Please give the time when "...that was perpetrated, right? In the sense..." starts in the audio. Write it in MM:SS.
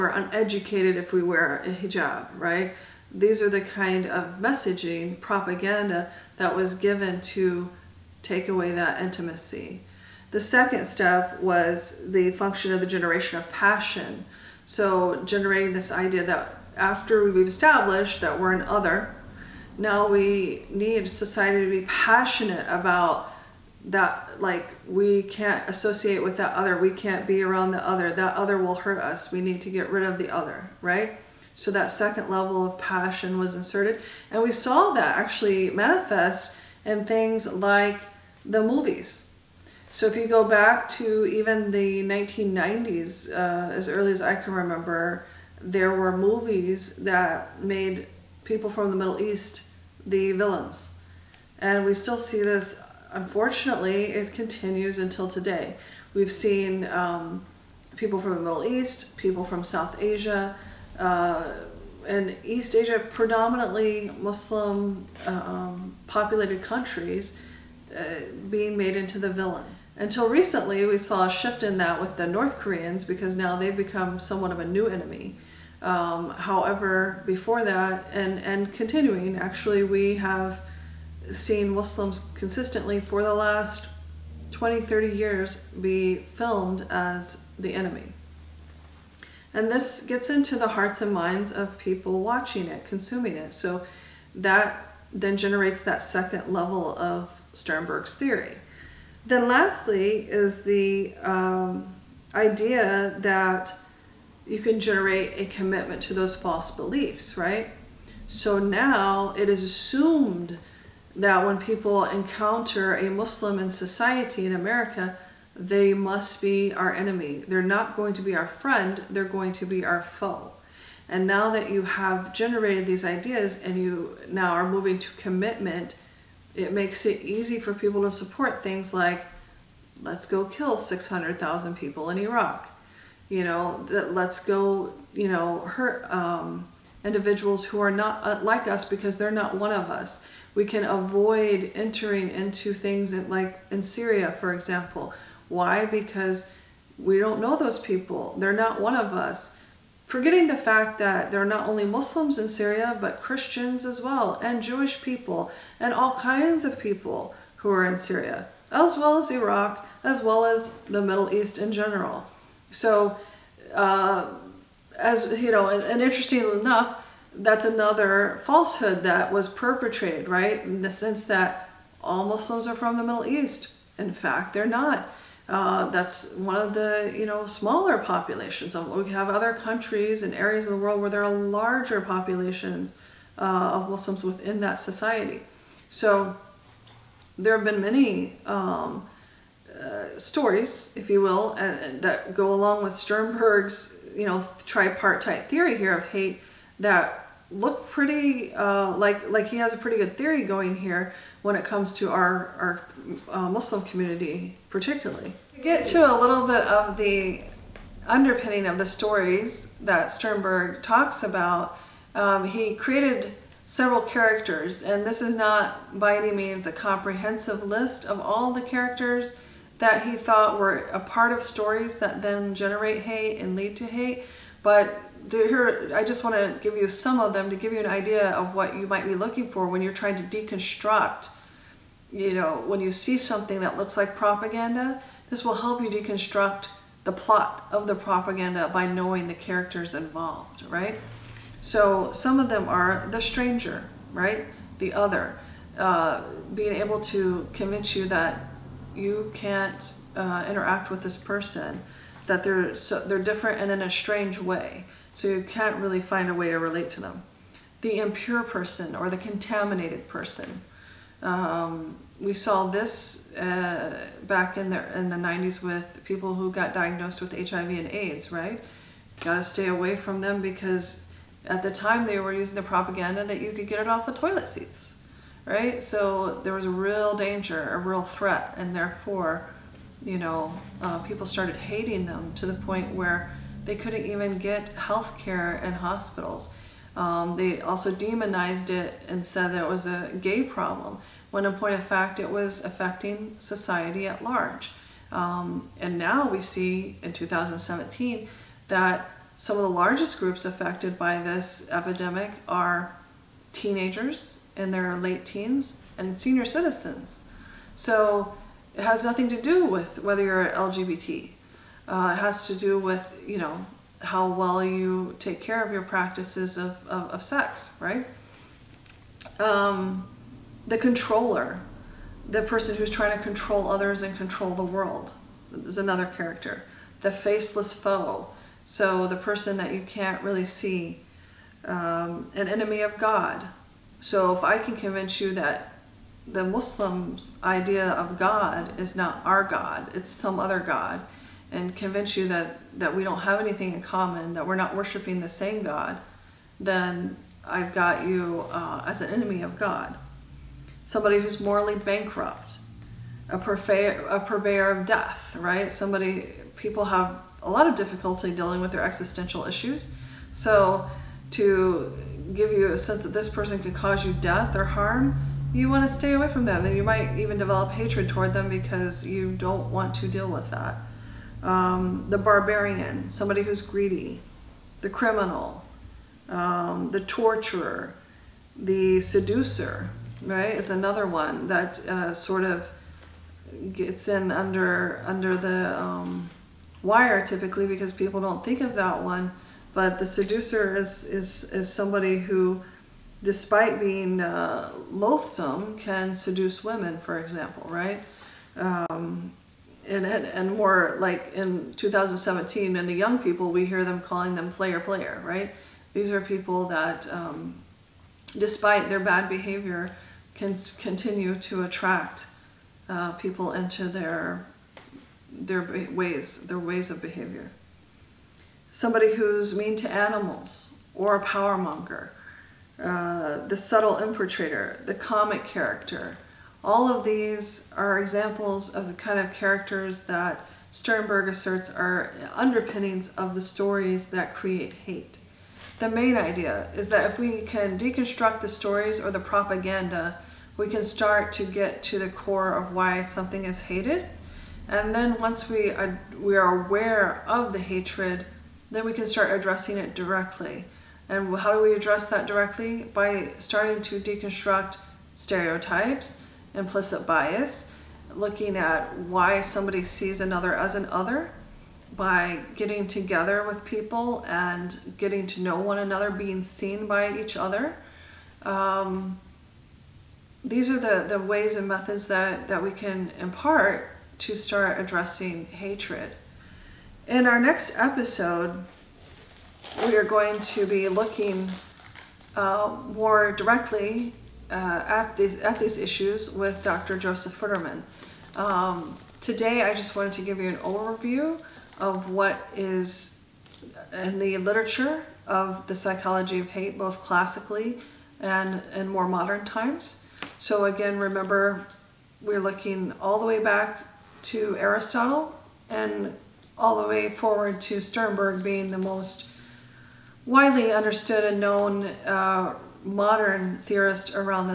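02:49.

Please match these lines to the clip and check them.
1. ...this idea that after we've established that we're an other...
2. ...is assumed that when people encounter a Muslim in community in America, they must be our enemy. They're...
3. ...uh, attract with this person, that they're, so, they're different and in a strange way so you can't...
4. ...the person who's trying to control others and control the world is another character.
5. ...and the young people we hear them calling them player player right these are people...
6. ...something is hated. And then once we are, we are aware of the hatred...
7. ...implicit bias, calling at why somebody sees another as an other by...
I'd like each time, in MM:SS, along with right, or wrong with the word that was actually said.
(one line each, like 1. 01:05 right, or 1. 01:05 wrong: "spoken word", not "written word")
1. 00:15 right
2. 01:49 wrong: "society", not "community"
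3. 04:10 wrong: "interact", not "attract"
4. 05:22 right
5. 06:42 right
6. 07:23 right
7. 07:36 wrong: "looking", not "calling".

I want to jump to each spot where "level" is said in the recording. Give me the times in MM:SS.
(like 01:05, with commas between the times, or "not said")
00:32, 01:36.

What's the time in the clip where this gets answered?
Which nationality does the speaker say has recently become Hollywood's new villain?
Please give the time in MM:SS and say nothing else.
01:12.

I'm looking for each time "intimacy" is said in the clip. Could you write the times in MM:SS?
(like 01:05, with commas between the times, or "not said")
00:09.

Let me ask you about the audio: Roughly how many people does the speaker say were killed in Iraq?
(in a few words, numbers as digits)
600,000.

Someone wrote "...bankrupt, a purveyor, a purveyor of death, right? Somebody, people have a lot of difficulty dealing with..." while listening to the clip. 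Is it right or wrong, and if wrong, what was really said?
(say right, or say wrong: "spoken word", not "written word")
right.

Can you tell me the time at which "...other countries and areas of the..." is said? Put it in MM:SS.
02:59.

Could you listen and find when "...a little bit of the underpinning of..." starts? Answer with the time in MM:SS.
03:26.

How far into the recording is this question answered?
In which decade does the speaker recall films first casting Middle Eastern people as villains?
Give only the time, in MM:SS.
00:42.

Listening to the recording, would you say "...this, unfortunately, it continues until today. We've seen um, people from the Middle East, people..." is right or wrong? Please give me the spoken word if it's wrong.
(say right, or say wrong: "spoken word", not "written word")
right.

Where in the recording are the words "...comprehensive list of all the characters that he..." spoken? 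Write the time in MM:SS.
03:36.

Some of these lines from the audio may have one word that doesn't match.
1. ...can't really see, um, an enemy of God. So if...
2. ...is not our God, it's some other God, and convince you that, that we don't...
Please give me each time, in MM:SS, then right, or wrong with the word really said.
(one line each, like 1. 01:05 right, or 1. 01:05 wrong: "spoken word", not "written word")
1. 05:29 right
2. 05:38 right.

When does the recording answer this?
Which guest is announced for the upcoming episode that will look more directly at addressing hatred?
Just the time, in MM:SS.
08:06.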